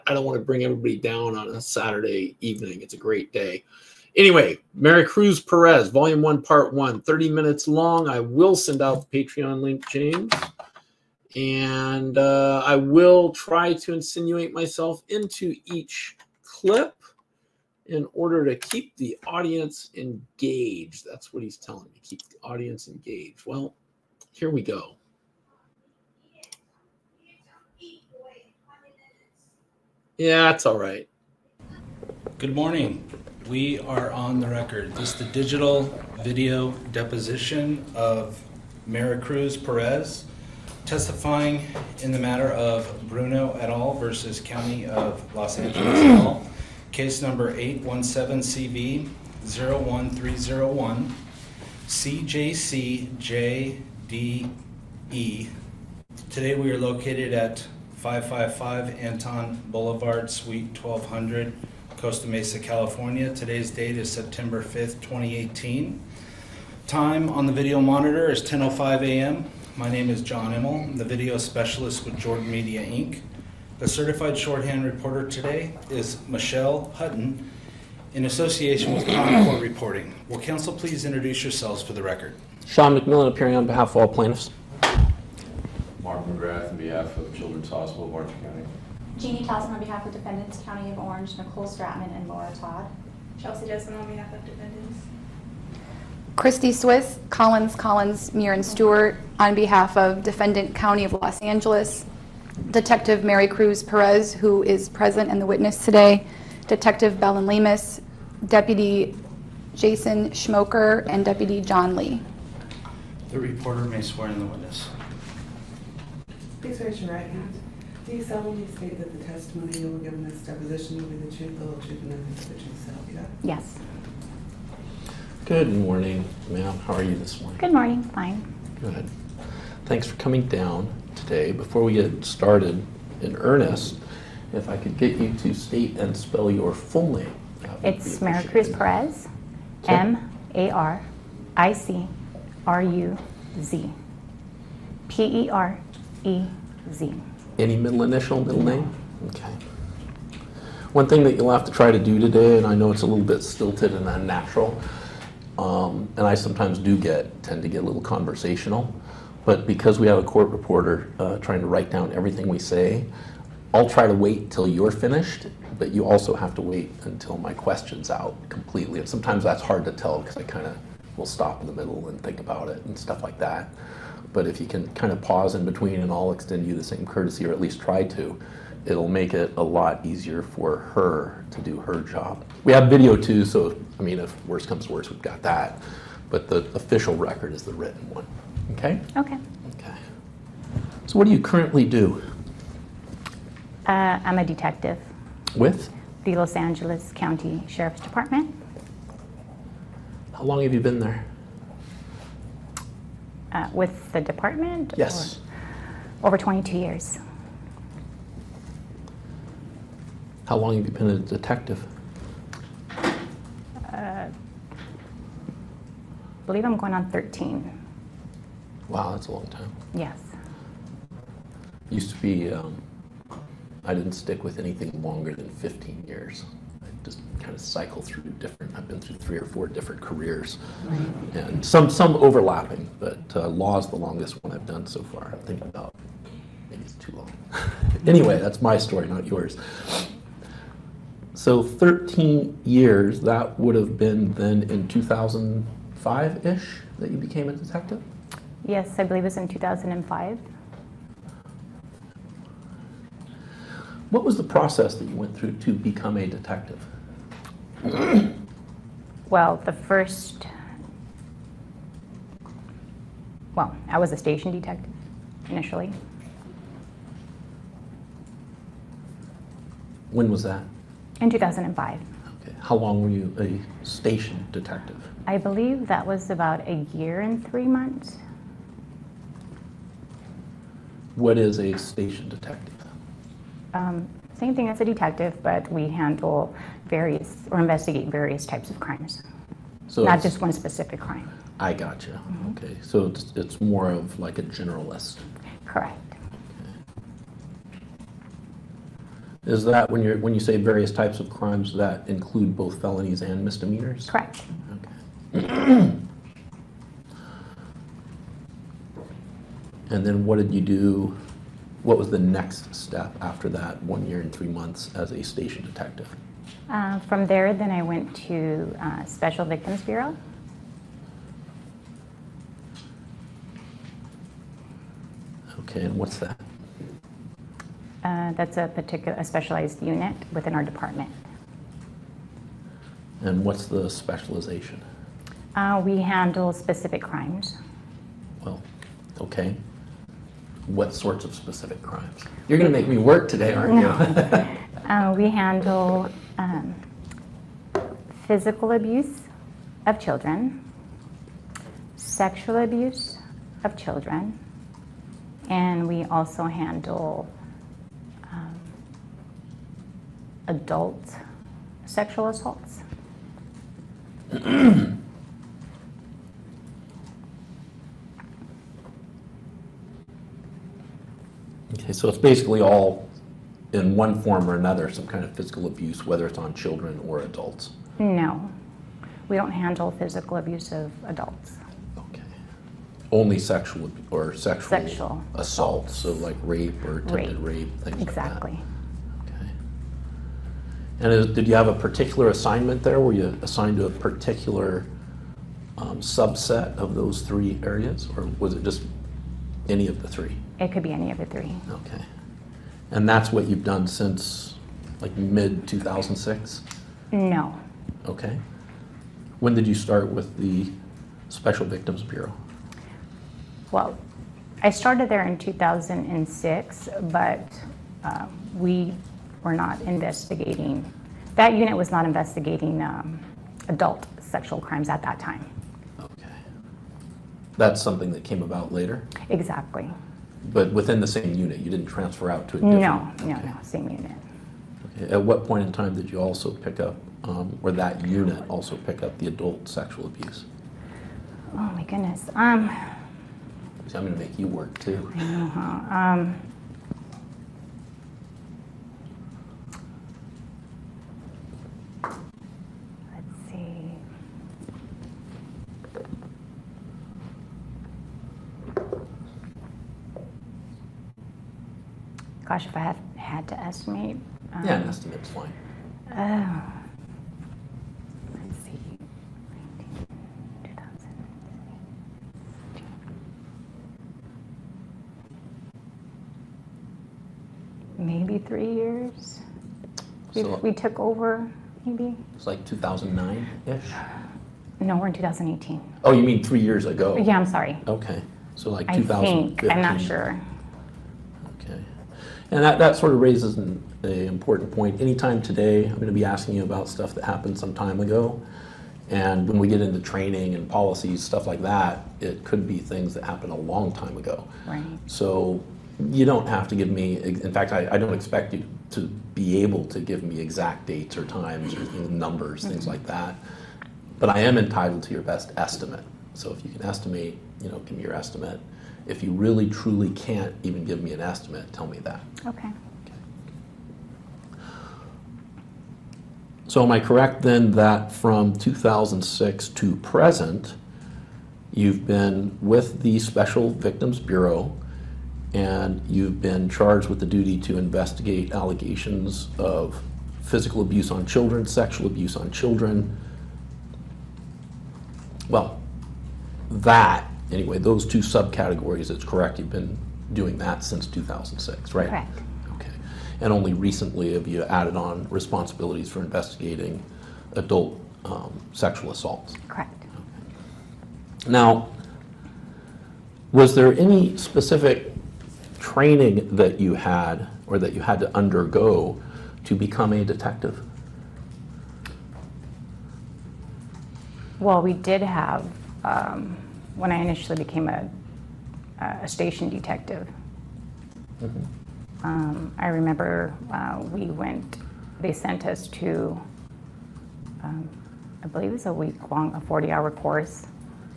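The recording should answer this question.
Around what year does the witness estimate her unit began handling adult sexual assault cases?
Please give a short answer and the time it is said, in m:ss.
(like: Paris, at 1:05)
2015, at 8:08.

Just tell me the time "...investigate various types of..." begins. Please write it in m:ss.
4:47.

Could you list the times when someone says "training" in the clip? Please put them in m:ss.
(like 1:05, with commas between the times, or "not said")
8:19, 9:25.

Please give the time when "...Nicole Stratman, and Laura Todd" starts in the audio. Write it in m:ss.
1:31.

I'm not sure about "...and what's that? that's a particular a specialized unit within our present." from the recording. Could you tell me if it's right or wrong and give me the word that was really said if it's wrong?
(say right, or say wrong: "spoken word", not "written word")
wrong: "department", not "present".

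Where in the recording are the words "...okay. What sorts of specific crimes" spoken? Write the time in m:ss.
5:39.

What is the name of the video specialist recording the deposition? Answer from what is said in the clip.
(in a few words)
John Immel.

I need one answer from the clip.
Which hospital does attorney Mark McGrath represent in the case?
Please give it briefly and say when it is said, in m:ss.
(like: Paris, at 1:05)
Children's Hospital of Orange County, at 1:27.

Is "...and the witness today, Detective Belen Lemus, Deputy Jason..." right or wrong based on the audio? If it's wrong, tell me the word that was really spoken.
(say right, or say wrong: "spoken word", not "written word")
right.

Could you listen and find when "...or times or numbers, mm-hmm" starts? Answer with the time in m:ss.
8:31.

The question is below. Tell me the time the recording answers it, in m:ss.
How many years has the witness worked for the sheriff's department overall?
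3:26.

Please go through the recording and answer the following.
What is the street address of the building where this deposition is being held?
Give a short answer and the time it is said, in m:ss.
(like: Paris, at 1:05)
555 Anton Boulevard, at 0:57.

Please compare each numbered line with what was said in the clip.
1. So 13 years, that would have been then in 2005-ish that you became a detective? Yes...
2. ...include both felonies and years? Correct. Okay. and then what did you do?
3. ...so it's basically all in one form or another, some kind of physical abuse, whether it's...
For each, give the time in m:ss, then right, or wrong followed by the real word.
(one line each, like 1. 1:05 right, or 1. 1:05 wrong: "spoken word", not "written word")
1. 4:01 right
2. 5:02 wrong: "misdemeanors", not "years"
3. 6:11 right.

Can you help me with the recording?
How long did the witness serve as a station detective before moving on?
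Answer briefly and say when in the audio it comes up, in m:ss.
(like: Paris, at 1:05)
a year and three months, at 4:36.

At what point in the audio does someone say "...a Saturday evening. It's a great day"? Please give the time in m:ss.
0:01.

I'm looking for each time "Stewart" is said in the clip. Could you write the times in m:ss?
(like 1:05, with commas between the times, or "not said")
1:38.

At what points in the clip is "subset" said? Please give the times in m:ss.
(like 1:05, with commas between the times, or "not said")
6:35.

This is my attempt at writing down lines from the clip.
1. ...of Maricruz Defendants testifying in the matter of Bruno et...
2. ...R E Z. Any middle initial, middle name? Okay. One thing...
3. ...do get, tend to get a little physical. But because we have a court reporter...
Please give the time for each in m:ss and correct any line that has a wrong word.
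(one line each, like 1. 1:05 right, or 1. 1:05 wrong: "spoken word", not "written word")
1. 0:37 wrong: "Perez", not "Defendants"
2. 2:25 right
3. 2:36 wrong: "conversational", not "physical".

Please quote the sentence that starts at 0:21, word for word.
That's what he's telling me, keep the audience engaged.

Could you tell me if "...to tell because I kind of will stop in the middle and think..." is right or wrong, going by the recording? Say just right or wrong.
right.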